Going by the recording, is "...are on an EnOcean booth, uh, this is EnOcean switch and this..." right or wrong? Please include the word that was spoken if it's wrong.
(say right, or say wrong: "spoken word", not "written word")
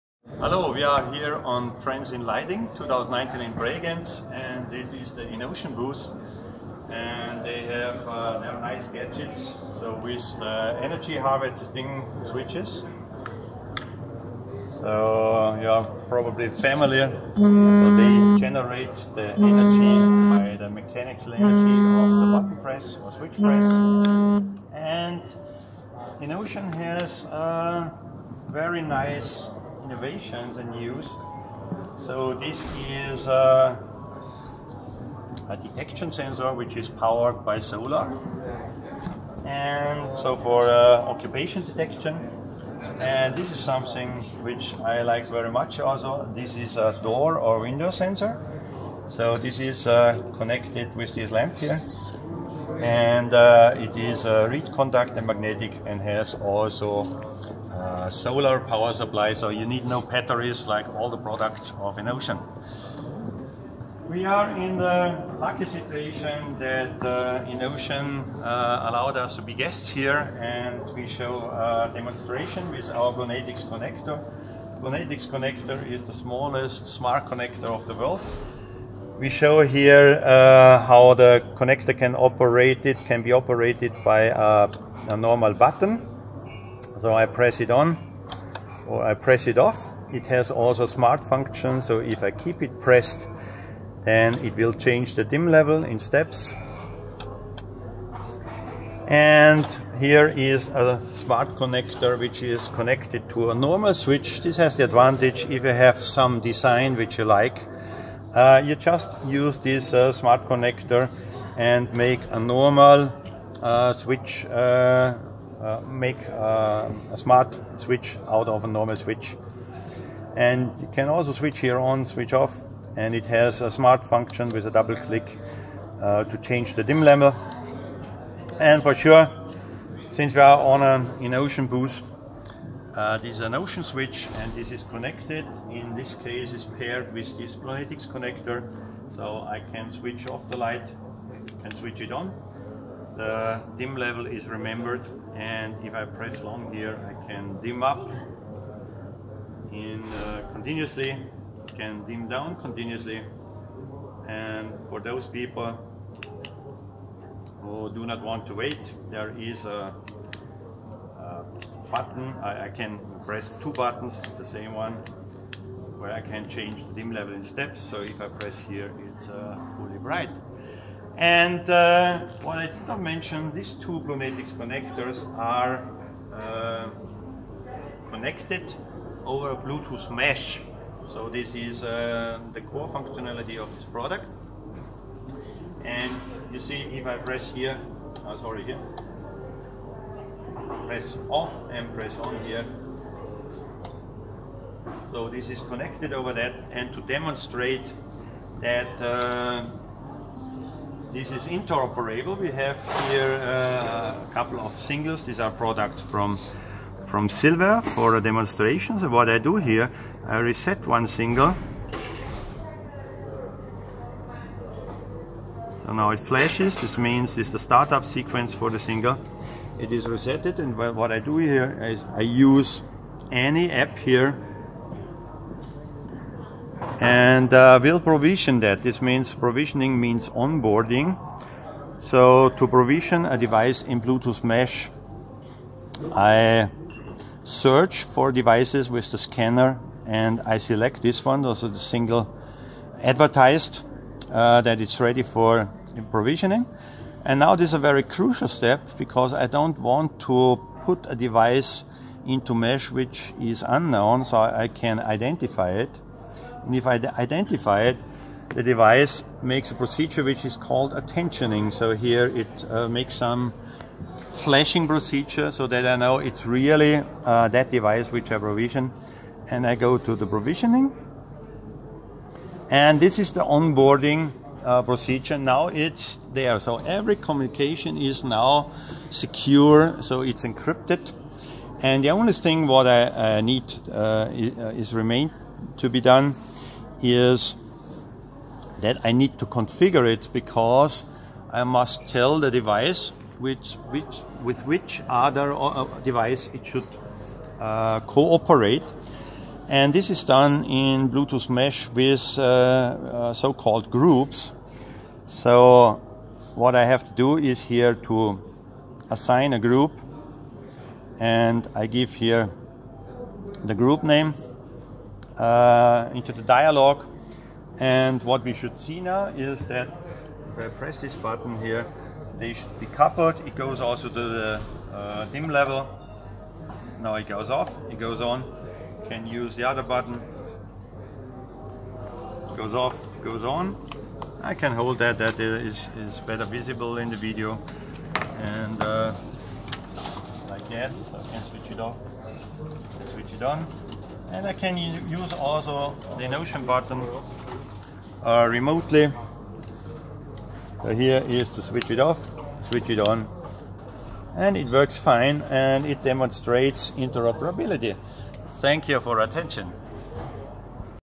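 right.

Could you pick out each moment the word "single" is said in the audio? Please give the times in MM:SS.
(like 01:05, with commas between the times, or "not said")
03:24, 03:31, 03:38, 04:01.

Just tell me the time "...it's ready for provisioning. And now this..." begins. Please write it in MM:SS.
04:04.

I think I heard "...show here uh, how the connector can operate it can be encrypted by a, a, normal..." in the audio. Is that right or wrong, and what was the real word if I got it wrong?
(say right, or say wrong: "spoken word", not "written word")
wrong: "operated", not "encrypted".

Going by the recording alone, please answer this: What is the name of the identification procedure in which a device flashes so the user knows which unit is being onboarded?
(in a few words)
Attentioning.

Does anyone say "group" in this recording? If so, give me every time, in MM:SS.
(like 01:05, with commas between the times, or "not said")
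05:03, 05:09, 05:13.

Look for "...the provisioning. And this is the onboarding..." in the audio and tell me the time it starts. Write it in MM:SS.
04:30.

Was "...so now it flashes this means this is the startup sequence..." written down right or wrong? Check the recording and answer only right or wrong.
right.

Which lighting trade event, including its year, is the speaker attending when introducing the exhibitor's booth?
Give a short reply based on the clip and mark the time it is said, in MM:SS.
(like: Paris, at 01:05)
Trends in Lighting 2019, at 00:01.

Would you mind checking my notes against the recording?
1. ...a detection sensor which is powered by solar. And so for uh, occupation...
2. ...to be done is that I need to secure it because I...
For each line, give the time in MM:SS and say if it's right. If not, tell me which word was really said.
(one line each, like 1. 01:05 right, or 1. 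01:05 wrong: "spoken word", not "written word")
1. 00:35 right
2. 04:45 wrong: "configure", not "secure".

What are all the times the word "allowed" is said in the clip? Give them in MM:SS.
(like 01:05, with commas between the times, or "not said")
01:08.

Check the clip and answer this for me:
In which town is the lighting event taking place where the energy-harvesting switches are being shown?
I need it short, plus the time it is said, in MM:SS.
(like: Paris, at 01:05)
Bregenz, at 00:03.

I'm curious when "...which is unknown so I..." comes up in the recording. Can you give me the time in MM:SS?
04:12.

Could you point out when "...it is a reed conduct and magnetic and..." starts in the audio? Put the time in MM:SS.
00:53.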